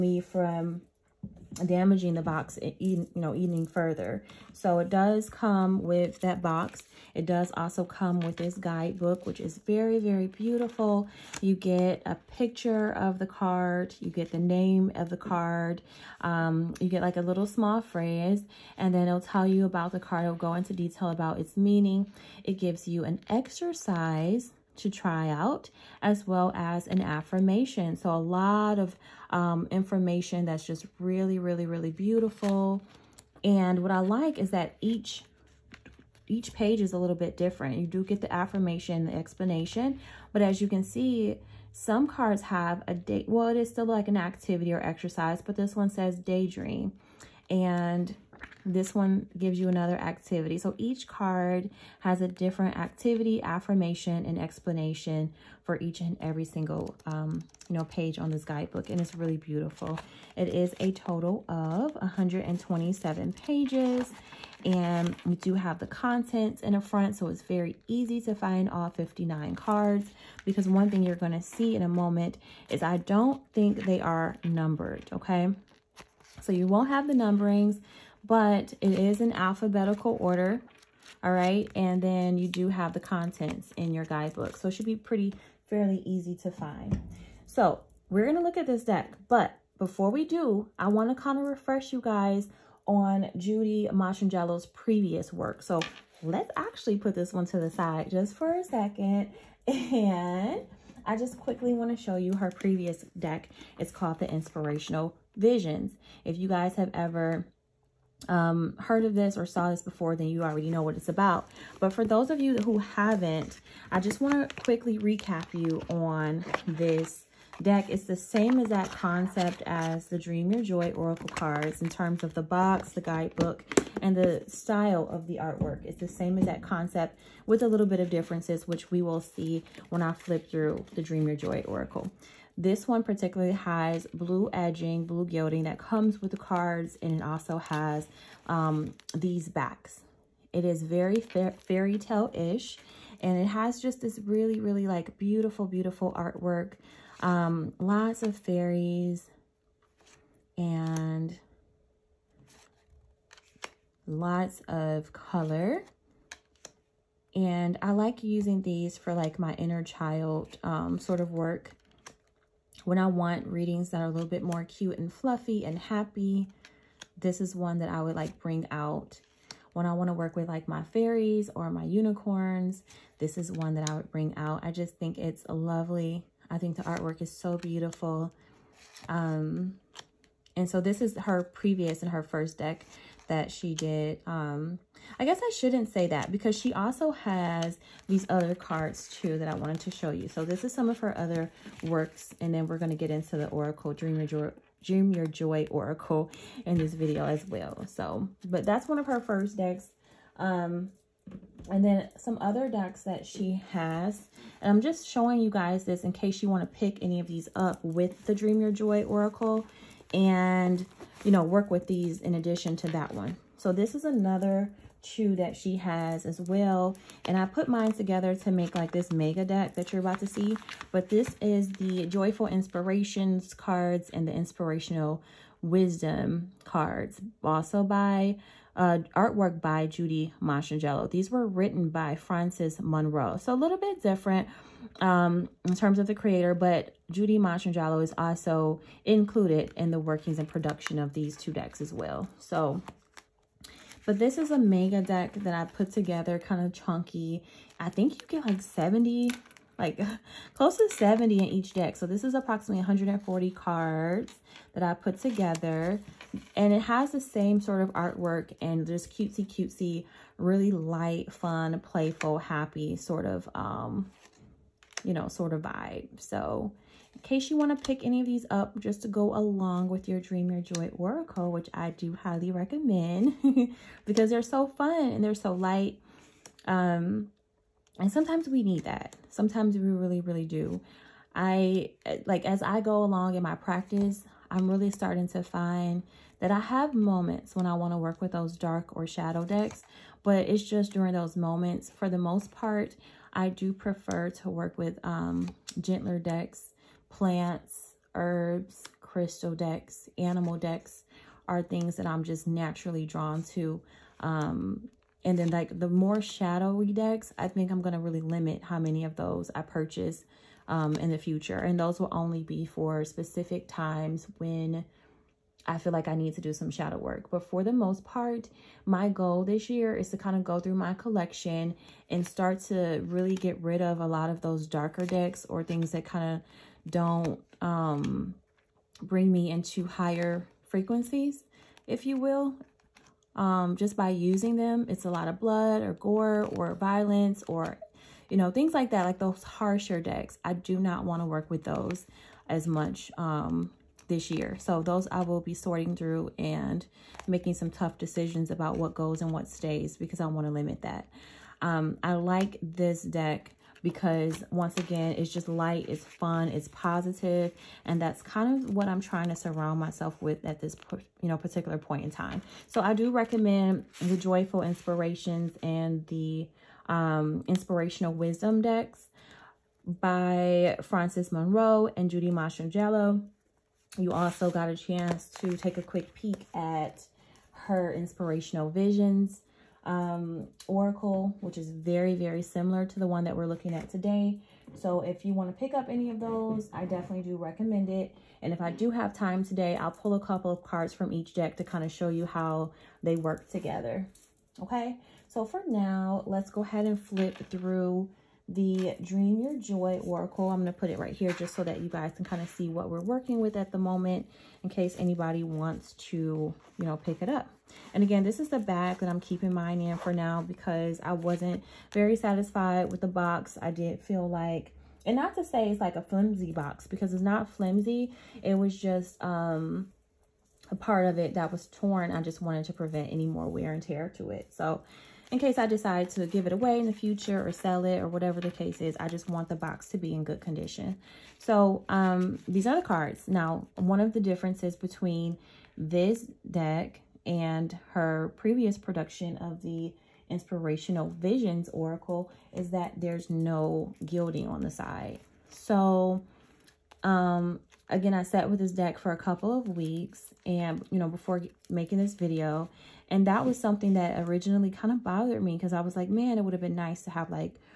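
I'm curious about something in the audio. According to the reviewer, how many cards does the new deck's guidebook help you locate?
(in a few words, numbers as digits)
59.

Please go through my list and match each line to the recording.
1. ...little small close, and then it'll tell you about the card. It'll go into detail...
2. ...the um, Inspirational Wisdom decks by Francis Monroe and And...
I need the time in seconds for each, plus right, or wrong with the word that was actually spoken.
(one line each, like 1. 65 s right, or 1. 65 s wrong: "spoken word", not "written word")
1. 17 s wrong: "phrase", not "close"
2. 366 s wrong: "Judy", not "And".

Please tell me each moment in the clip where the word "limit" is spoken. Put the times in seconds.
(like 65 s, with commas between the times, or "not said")
308 s, 350 s.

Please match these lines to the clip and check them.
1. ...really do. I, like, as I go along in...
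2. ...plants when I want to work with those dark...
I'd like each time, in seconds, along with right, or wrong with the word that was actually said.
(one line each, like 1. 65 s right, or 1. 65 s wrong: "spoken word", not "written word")
1. 280 s right
2. 286 s wrong: "moments", not "plants".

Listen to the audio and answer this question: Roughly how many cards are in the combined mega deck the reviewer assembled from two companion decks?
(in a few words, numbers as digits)
140.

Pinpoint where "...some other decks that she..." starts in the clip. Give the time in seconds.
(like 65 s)
202 s.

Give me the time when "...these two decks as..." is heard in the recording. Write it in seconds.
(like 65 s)
241 s.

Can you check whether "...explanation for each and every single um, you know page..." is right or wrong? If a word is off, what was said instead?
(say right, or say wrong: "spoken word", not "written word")
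right.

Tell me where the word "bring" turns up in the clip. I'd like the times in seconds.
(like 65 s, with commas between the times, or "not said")
168 s, 174 s, 329 s.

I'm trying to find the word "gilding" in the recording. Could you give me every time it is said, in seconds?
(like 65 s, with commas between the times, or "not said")
135 s, 444 s.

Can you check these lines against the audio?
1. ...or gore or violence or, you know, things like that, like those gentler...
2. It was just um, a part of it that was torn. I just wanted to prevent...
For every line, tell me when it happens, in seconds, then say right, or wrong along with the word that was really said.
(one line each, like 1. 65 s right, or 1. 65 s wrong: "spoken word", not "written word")
1. 335 s wrong: "harsher", not "gentler"
2. 418 s right.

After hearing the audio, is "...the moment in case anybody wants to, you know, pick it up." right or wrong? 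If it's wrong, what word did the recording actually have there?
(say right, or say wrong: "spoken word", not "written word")
right.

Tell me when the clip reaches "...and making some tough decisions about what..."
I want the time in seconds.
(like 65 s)
346 s.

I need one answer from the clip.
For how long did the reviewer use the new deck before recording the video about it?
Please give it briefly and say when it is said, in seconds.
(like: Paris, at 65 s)
A couple of weeks, at 449 s.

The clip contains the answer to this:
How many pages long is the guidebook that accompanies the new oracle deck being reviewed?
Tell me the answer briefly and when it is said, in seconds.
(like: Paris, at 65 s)
127, at 61 s.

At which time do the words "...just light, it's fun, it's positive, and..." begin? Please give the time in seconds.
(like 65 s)
355 s.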